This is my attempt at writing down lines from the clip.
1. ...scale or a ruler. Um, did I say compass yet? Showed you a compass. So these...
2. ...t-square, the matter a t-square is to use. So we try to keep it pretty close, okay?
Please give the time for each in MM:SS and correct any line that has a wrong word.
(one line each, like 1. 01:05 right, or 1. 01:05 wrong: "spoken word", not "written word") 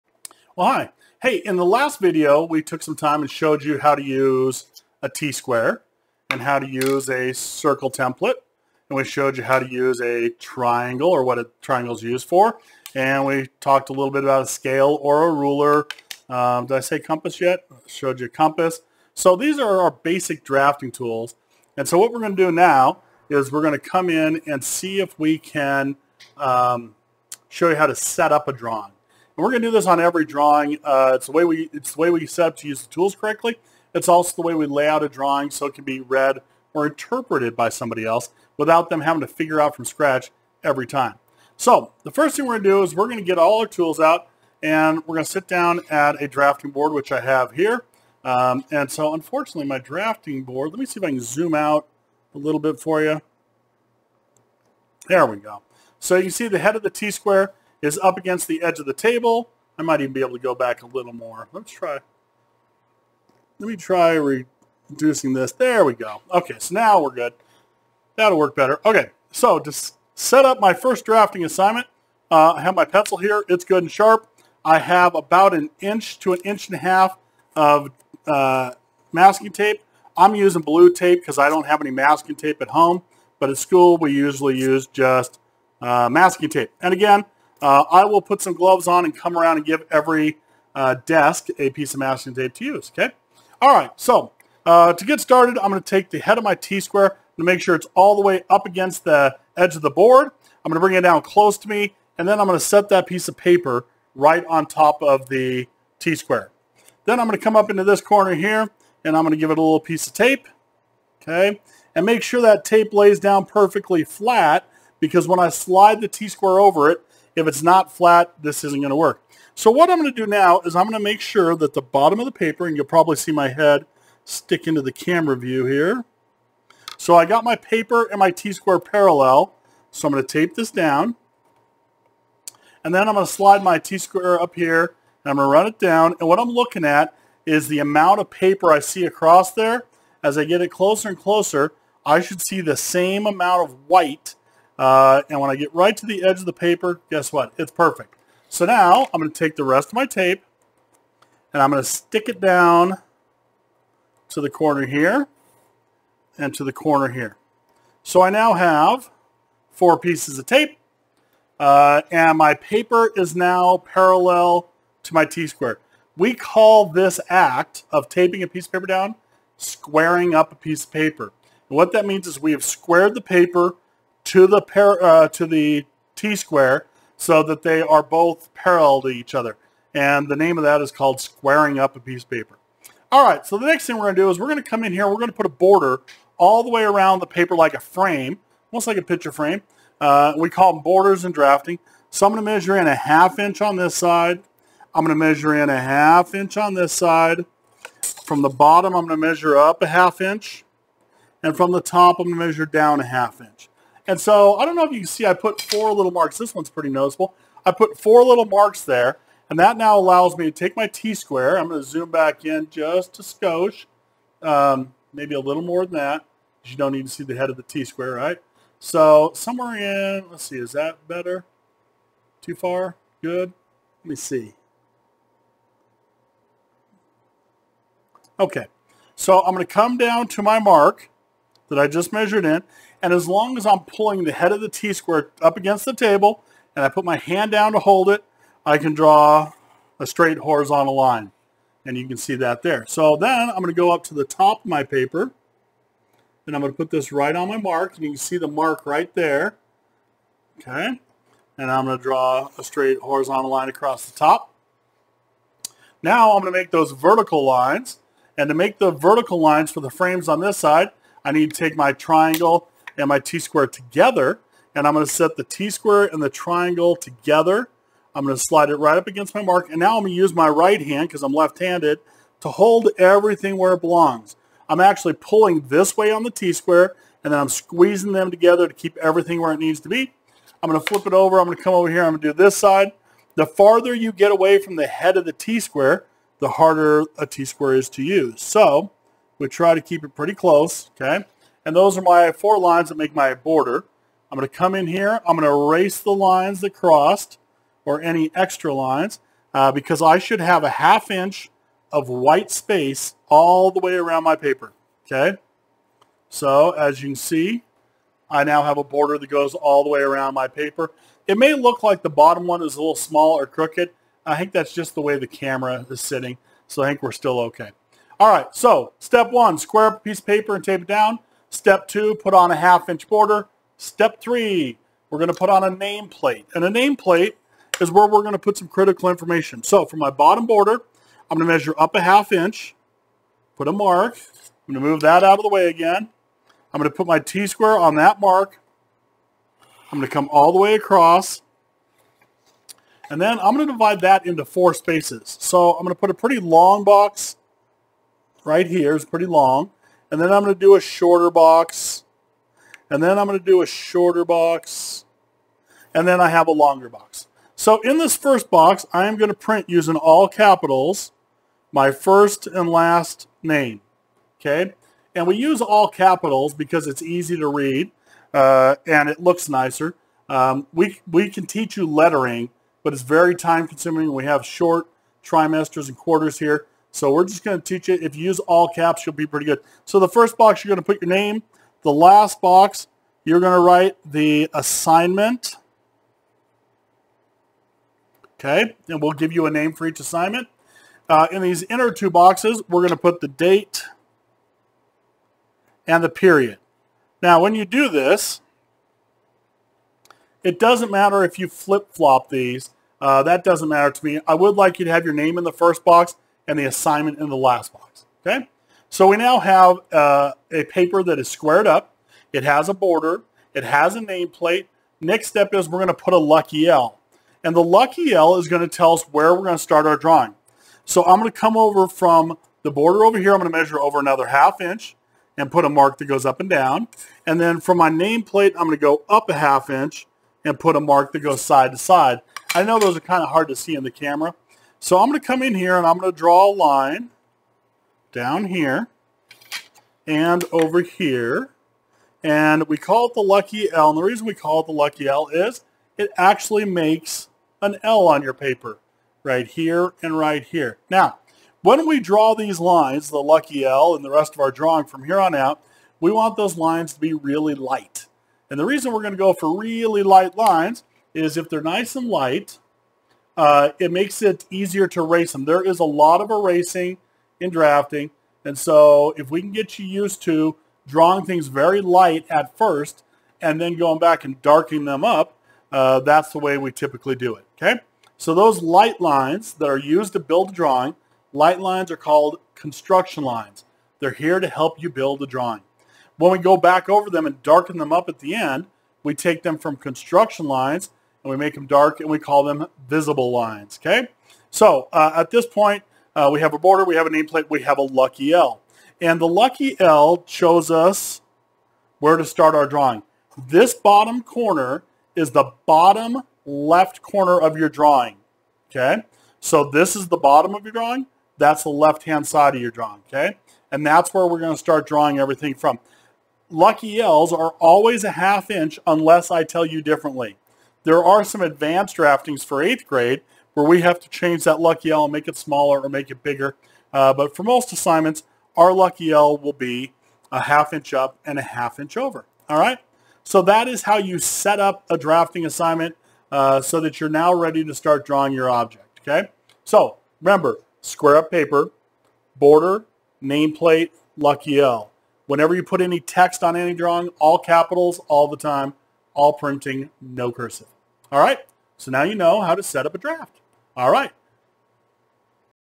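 1. 00:14 right
2. 04:45 wrong: "harder", not "matter".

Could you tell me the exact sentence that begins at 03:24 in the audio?
And so I don't know if you can see I put four little marks.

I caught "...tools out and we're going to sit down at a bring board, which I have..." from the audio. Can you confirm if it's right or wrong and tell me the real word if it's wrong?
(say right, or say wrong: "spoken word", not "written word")
wrong: "drafting", not "bring".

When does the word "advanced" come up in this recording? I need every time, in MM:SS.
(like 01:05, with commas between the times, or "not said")
08:41.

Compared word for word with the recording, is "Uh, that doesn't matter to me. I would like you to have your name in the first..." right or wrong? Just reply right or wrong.
right.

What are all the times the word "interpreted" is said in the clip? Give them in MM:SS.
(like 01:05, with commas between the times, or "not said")
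00:36.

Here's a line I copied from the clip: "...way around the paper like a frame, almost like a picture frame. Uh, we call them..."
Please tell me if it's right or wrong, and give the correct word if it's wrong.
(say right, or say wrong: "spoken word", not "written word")
right.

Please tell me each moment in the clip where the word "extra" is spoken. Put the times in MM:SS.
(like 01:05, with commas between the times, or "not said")
04:58.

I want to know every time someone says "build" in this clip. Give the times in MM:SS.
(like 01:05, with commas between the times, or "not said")
08:00, 08:04.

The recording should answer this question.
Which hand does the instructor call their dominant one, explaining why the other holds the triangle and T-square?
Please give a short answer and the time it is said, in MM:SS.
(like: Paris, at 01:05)
Left, at 04:31.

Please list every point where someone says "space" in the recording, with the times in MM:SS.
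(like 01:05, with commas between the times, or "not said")
05:02, 05:44.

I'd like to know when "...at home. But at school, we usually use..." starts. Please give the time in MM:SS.
01:22.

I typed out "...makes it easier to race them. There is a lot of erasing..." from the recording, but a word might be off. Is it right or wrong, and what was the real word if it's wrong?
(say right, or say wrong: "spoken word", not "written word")
right.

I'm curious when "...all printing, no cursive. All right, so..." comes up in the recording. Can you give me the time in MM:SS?
09:09.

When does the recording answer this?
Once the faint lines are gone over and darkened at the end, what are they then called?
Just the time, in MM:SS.
08:12.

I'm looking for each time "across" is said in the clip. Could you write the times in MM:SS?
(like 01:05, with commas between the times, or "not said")
02:19, 04:13, 05:40.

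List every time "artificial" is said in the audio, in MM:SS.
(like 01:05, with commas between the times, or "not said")
not said.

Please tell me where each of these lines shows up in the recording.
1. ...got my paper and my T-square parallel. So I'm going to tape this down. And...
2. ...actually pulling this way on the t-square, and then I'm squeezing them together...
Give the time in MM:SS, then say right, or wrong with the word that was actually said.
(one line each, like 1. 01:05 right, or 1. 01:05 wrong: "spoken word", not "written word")
1. 02:07 right
2. 04:34 right.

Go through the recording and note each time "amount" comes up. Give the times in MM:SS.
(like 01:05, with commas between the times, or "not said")
02:17, 02:23.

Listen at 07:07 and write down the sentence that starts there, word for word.
And then from my nameplate, I'm going to go up a half inch and put a mark that goes side to side.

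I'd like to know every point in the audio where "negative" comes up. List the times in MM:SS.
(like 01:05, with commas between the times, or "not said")
not said.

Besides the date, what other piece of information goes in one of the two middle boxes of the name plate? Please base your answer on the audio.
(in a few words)
Period.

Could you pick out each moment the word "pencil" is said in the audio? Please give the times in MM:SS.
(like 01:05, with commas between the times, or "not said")
01:12.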